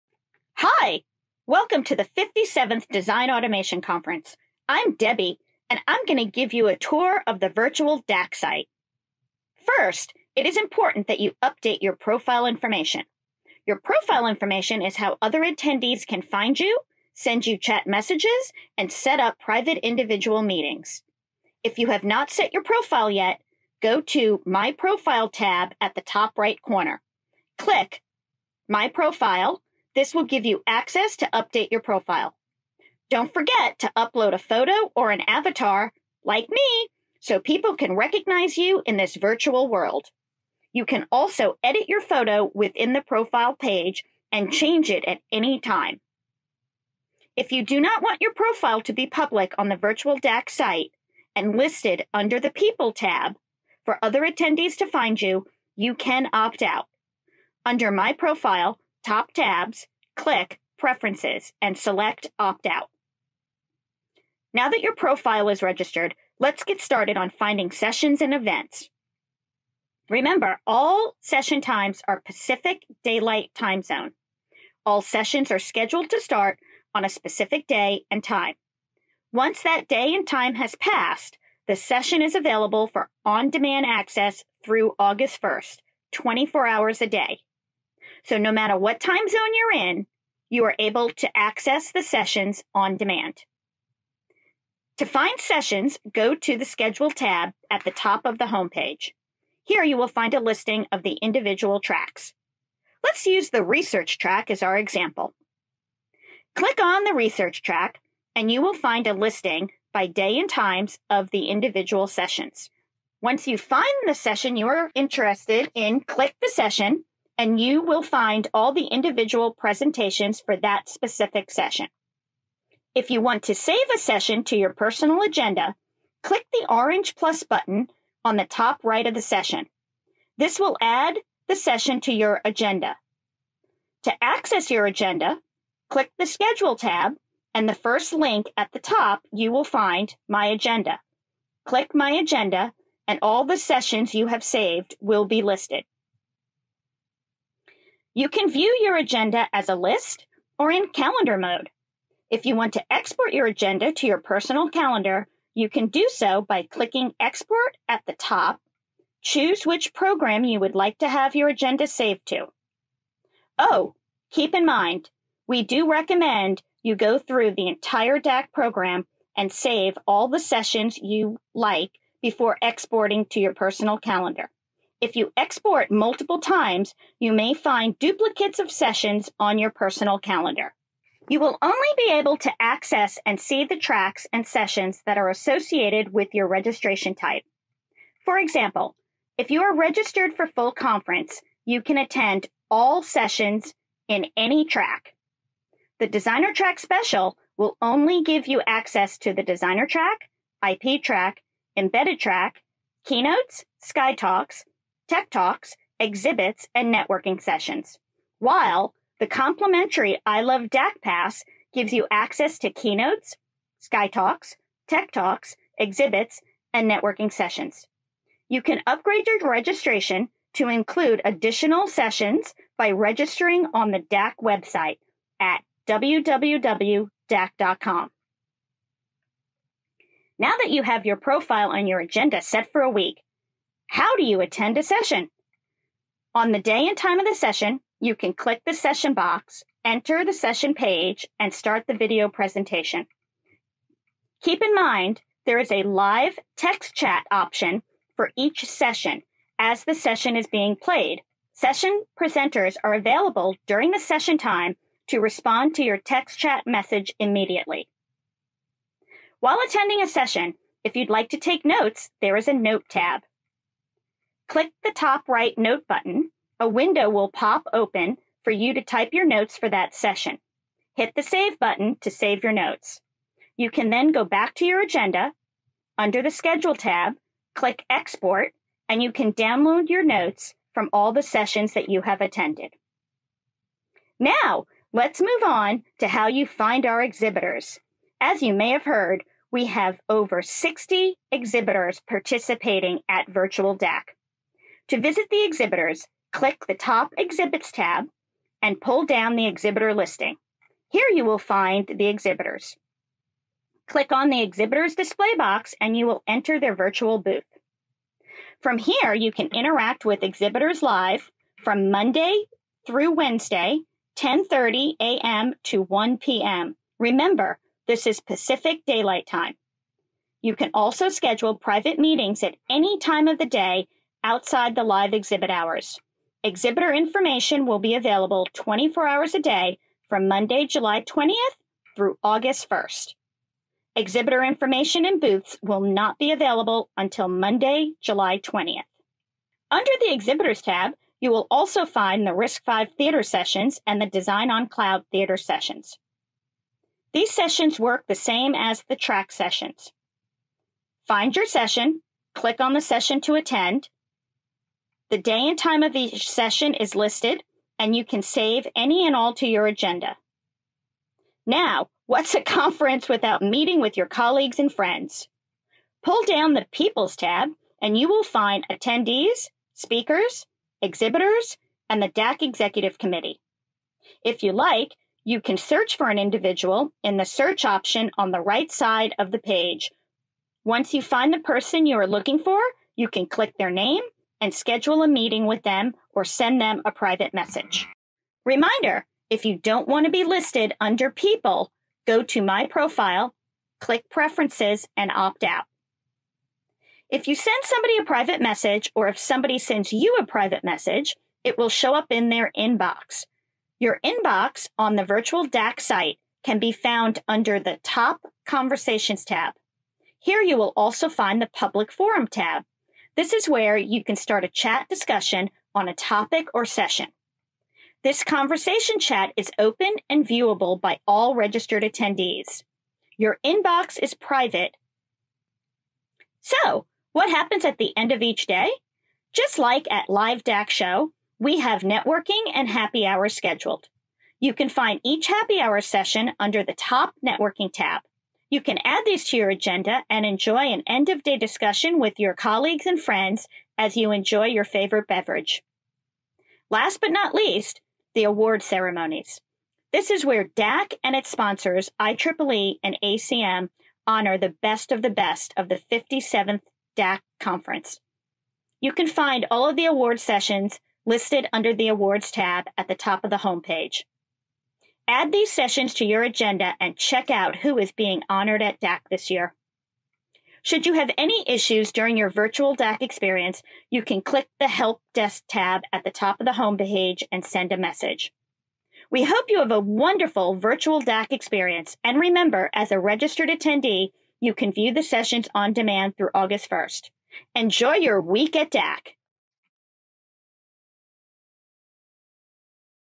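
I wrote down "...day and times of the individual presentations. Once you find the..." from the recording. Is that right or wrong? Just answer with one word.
wrong.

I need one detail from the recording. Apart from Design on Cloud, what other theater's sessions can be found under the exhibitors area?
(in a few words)
RISC-V.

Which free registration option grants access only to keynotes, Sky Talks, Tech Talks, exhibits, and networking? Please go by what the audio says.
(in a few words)
I Love DAC Pass.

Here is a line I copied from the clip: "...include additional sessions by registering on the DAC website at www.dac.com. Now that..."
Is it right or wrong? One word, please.
right.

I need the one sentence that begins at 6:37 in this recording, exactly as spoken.
If you send somebody a private message or if somebody sends you a private message, it will show up in their inbox.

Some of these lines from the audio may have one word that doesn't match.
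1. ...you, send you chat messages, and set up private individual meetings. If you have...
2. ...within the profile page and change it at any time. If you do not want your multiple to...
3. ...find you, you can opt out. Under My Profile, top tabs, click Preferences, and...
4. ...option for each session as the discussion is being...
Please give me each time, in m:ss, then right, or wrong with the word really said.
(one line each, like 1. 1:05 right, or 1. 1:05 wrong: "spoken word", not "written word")
1. 0:16 right
2. 0:42 wrong: "profile", not "multiple"
3. 0:54 right
4. 4:07 wrong: "session", not "discussion".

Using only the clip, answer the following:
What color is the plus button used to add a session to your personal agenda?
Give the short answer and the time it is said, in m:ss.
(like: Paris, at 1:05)
Orange, at 2:06.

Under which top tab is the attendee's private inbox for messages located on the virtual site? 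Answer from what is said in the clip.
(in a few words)
Conversations.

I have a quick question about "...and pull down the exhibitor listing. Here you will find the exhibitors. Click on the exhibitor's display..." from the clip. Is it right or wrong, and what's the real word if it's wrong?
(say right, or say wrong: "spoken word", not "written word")
right.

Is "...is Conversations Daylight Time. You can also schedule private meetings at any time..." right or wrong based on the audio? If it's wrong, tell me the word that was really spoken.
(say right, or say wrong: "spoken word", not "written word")
wrong: "Pacific", not "Conversations".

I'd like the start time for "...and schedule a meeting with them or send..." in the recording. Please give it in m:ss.
6:24.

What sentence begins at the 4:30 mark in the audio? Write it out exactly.
Hit the save button to save your notes.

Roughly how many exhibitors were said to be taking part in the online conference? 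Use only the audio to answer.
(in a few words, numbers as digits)
over 60.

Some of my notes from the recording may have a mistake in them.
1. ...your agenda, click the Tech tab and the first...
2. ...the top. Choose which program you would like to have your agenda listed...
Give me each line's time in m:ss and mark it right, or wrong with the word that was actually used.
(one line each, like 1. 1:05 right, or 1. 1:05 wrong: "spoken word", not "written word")
1. 2:14 wrong: "Schedule", not "Tech"
2. 2:38 wrong: "saved", not "listed".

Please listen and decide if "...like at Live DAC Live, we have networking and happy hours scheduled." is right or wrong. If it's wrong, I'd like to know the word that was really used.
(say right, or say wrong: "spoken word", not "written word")
wrong: "Show", not "Live".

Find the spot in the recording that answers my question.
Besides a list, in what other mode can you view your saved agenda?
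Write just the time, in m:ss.
2:30.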